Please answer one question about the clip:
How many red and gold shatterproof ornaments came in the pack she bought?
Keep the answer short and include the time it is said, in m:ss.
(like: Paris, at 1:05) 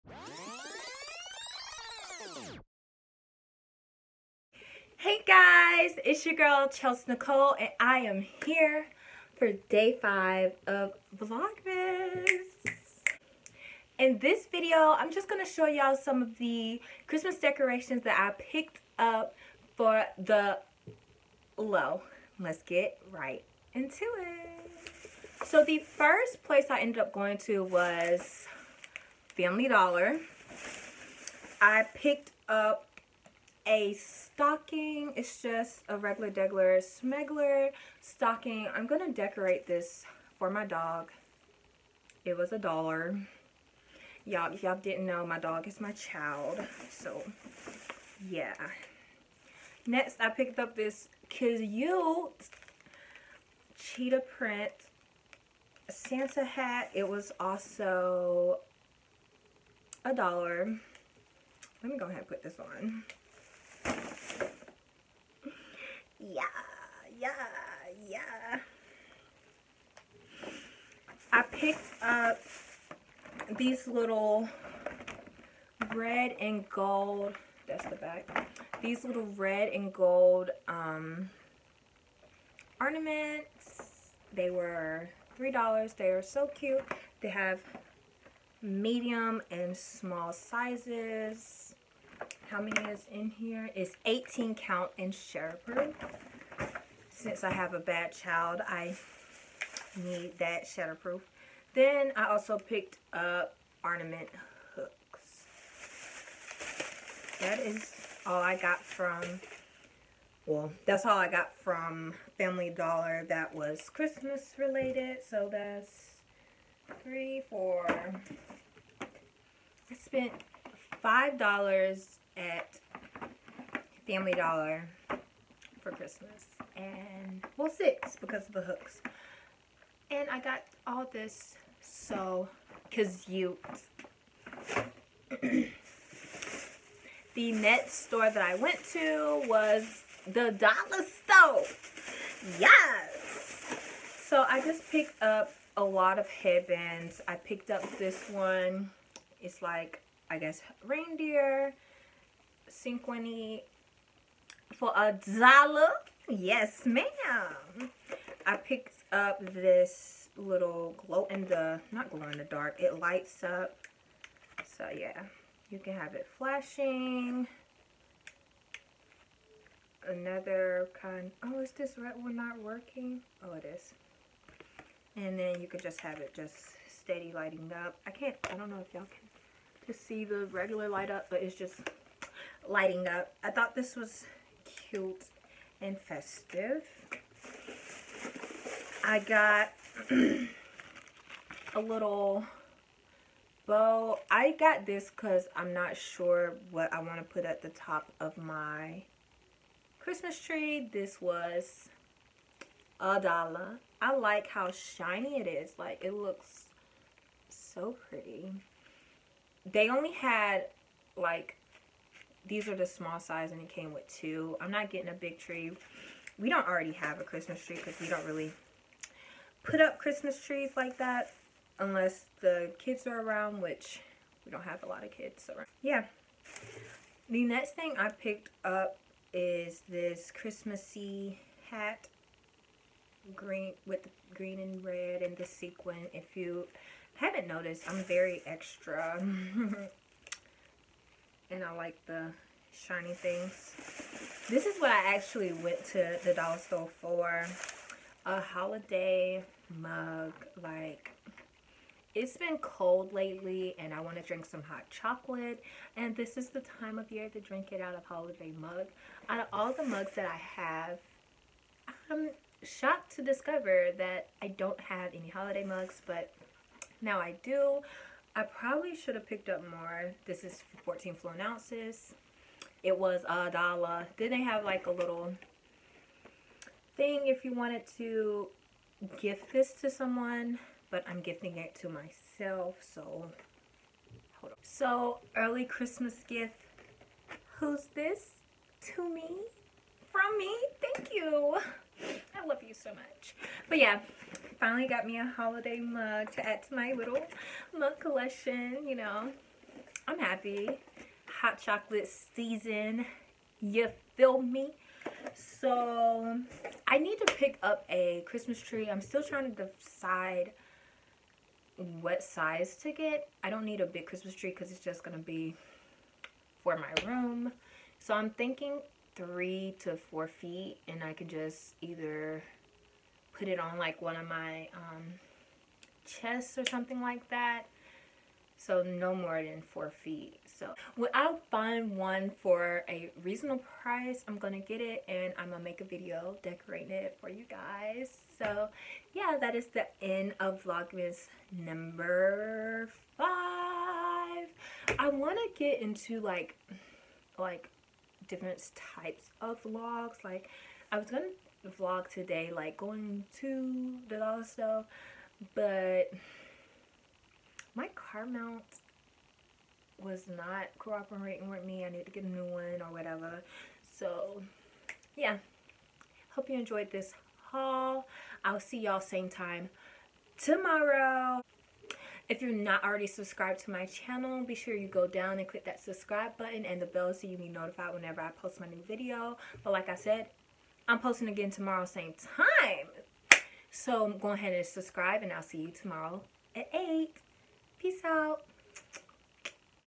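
18, at 1:34.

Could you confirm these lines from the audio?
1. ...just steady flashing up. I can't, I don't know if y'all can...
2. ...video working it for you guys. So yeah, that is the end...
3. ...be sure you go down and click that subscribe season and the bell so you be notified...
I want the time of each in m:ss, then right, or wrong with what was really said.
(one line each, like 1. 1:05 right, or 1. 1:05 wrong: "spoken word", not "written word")
1. 2:56 wrong: "lighting", not "flashing"
2. 5:35 wrong: "decorating", not "working"
3. 6:14 wrong: "button", not "season".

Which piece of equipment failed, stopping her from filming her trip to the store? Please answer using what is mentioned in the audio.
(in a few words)
car mount.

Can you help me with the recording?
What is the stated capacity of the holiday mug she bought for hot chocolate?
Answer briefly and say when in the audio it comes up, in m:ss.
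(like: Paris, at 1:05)
14 fluid ounces, at 4:30.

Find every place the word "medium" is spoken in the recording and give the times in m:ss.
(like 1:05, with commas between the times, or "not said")
1:28.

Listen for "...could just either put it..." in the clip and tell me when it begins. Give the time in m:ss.
5:21.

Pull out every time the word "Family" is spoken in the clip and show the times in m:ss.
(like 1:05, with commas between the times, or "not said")
0:29, 1:52, 2:04.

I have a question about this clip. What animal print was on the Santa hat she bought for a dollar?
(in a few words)
cheetah.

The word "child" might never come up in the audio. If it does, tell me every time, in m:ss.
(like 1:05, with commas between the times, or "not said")
0:45, 1:38.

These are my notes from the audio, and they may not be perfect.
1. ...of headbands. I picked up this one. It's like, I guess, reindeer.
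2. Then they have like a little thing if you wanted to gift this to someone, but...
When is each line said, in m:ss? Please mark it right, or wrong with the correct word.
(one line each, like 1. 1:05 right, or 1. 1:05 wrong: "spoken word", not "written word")
1. 2:26 right
2. 4:34 right.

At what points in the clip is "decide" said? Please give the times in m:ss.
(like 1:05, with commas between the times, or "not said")
5:09.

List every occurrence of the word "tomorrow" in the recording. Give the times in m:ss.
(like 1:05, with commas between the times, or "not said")
6:10, 6:21, 6:25.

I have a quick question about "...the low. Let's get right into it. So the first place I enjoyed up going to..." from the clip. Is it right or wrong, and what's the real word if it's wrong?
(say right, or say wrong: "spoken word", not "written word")
wrong: "ended", not "enjoyed".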